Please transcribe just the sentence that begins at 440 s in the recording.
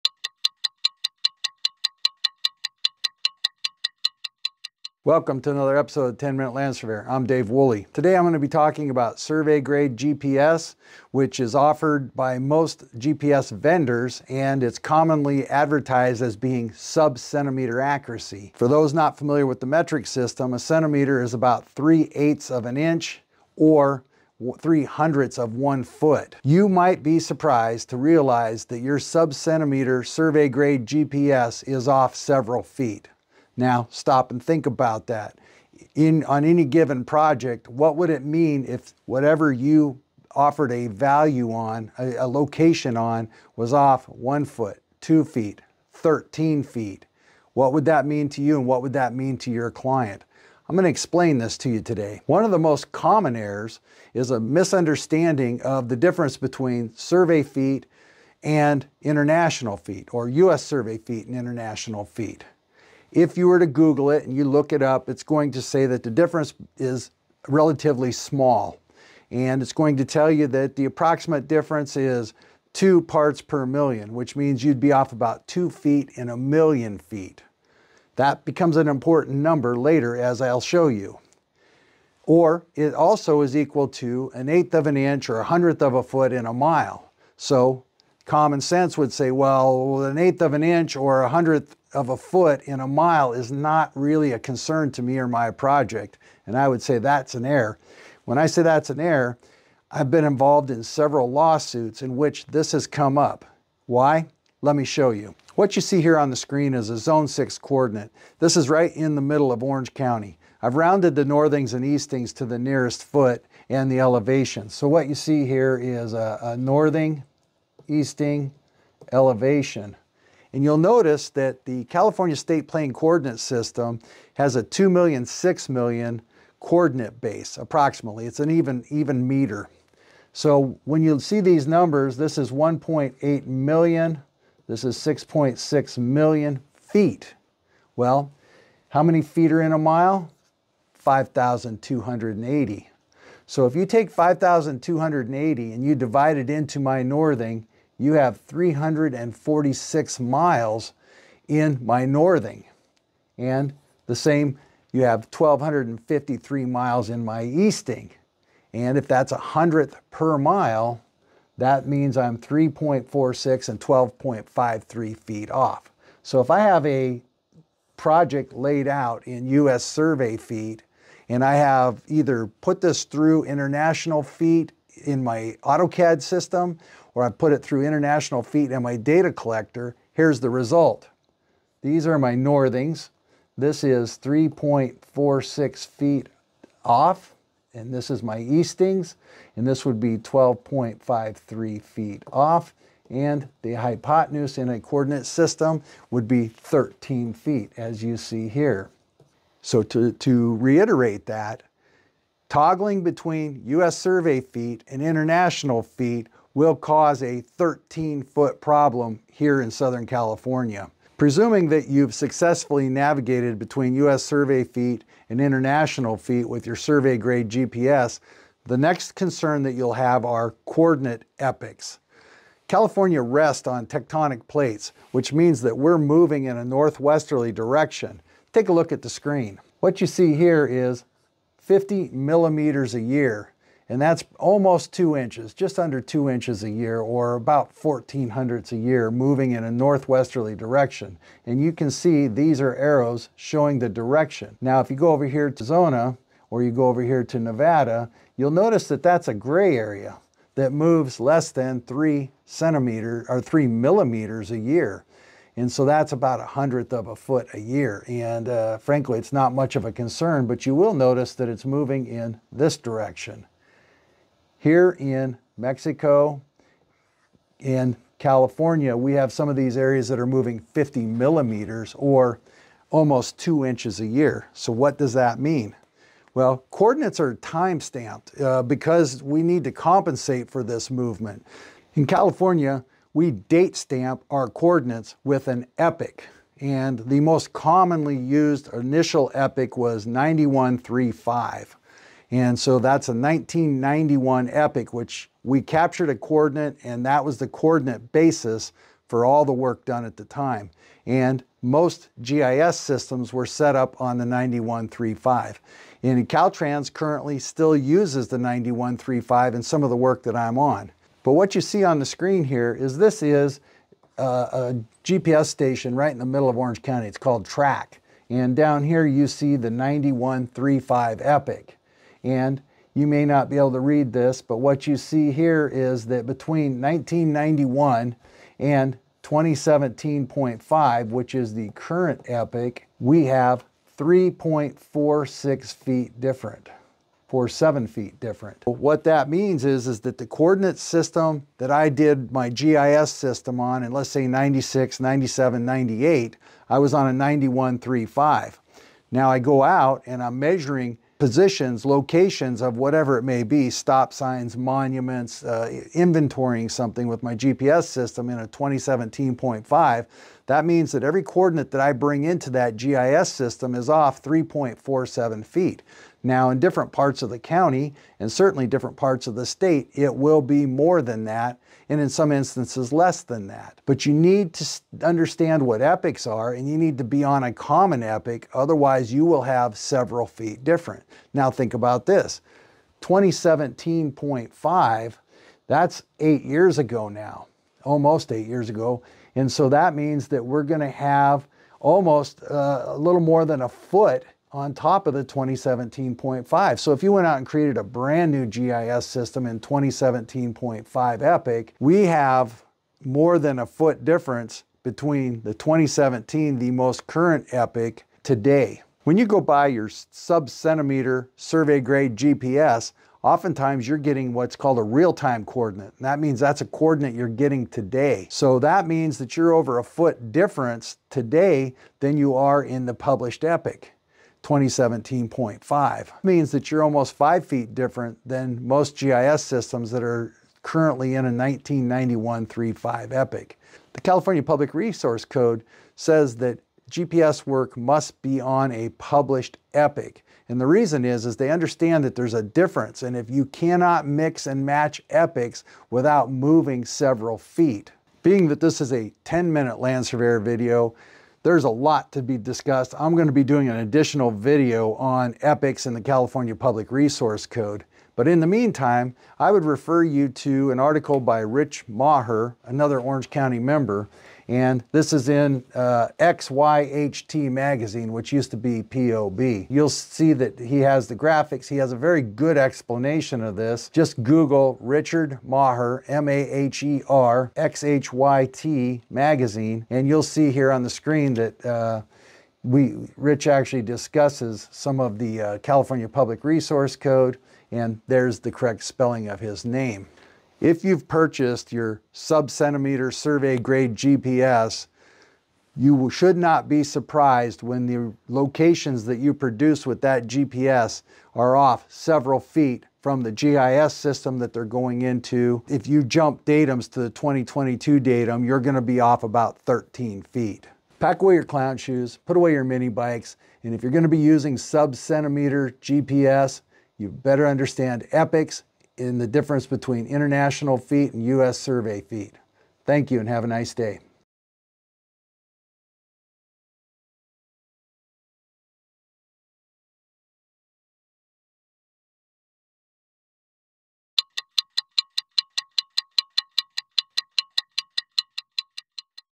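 And the reason is, is they understand that there's a difference.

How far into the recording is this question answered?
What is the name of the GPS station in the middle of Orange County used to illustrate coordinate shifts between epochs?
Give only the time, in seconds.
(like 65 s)
317 s.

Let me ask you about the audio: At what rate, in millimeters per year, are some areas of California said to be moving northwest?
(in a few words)
50 millimeters.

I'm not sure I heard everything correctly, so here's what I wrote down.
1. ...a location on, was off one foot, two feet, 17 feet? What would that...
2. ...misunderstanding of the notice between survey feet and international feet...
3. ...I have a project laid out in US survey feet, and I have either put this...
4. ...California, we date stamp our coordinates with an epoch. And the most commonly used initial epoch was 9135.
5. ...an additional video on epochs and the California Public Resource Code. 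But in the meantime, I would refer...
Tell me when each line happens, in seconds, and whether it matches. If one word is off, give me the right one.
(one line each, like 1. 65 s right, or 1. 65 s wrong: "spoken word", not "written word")
1. 42 s wrong: "13", not "17"
2. 54 s wrong: "difference", not "notice"
3. 166 s right
4. 282 s right
5. 453 s right.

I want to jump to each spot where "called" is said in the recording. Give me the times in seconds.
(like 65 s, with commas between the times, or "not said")
317 s, 414 s.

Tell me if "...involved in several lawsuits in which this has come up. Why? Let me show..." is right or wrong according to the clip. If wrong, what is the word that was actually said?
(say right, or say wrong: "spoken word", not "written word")
right.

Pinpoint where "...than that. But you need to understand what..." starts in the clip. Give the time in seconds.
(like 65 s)
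373 s.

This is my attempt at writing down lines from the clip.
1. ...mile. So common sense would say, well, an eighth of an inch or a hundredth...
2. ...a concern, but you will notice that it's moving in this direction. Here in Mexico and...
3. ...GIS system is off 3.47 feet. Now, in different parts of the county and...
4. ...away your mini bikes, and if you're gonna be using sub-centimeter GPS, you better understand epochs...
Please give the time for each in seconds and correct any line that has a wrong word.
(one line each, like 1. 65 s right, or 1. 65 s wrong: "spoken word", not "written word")
1. 86 s right
2. 259 s right
3. 362 s right
4. 512 s right.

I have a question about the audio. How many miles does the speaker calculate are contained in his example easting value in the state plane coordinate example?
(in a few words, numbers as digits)
1,253.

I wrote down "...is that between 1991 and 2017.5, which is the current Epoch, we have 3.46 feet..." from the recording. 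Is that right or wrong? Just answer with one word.
right.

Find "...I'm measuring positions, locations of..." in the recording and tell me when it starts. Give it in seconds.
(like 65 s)
350 s.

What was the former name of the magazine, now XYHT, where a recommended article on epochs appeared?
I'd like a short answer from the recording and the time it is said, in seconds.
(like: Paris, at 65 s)
POB, at 468 s.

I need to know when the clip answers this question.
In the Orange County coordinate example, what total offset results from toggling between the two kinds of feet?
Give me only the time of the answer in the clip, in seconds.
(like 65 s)
207 s.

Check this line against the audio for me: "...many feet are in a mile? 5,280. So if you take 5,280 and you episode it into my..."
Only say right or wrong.
wrong.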